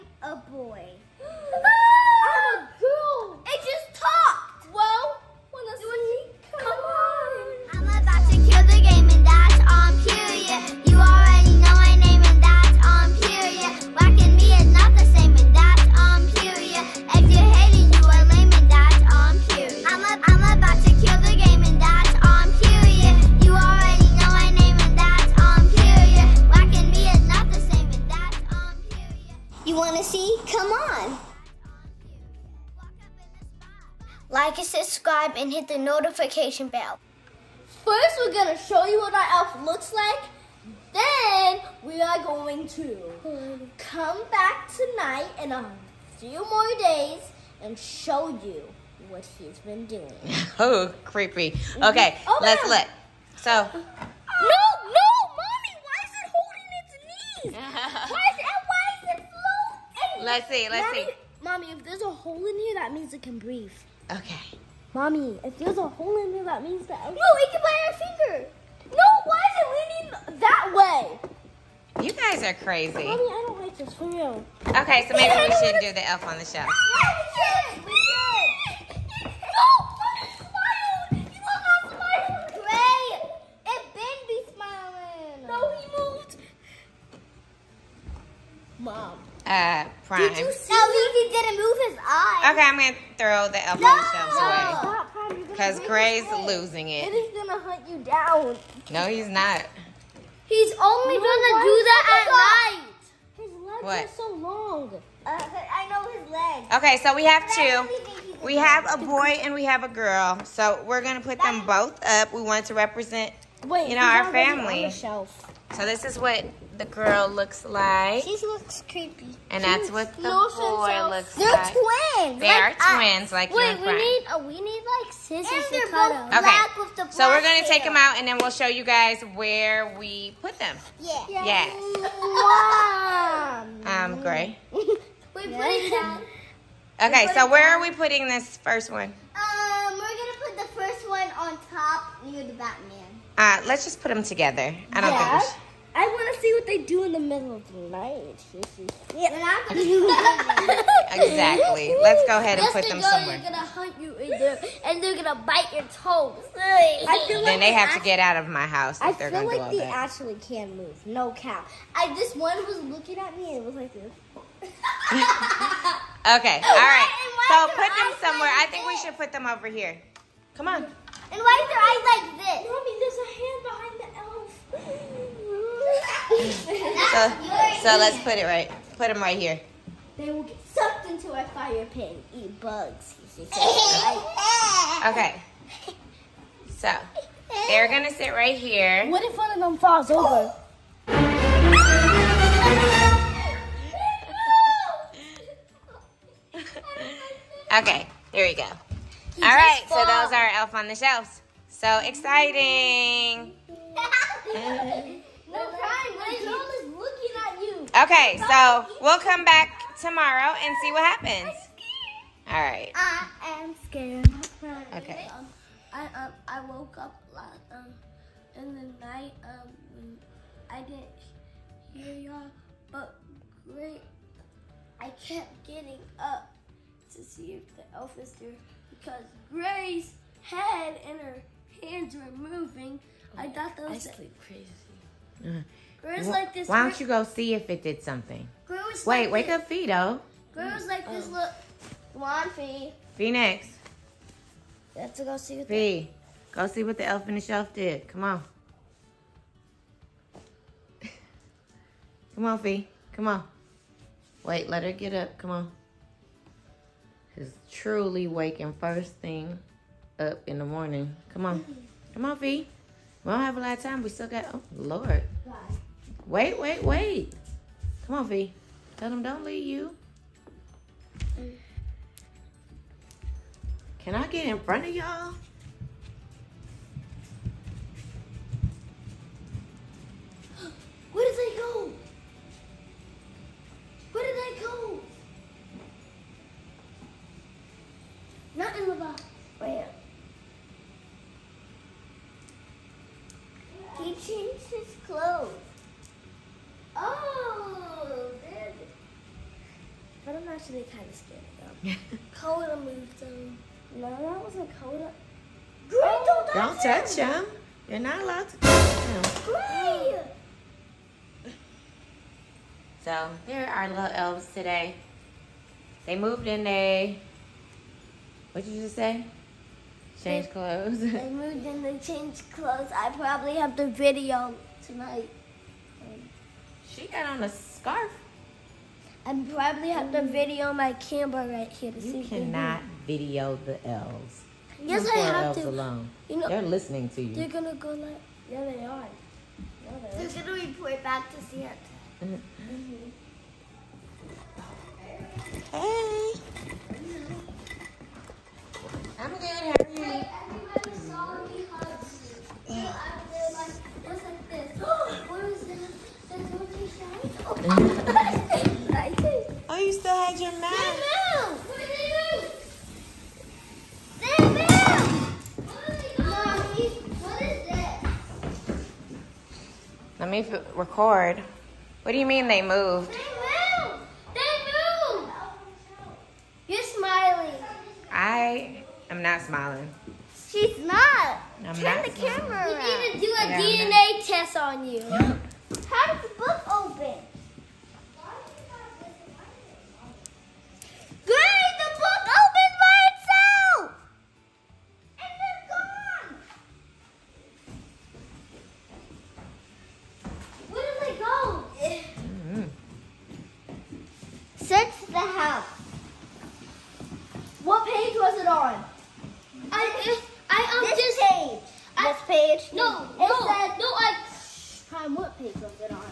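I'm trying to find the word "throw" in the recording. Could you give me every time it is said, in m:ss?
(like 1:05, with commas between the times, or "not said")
1:33.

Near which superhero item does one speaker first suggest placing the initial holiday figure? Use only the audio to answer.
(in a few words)
Batman.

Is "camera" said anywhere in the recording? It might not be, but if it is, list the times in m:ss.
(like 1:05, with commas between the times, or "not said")
5:30, 6:22.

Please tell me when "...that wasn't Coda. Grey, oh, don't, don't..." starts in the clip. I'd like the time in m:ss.
5:04.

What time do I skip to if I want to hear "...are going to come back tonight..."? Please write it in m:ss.
0:42.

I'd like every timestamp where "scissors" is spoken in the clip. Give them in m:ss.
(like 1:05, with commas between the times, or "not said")
2:05.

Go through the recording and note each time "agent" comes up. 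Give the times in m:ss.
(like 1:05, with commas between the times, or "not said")
not said.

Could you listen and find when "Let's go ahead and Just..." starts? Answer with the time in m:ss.
2:31.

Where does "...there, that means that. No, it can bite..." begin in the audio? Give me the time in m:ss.
1:06.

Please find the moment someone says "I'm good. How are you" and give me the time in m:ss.
5:49.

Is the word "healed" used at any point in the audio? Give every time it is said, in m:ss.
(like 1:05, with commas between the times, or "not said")
not said.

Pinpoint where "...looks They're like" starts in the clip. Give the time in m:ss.
2:01.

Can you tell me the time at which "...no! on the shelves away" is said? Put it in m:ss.
1:33.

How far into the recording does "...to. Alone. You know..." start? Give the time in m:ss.
5:35.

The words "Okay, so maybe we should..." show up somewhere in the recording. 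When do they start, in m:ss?
1:14.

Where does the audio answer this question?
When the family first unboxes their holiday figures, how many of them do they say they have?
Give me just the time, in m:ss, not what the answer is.
1:47.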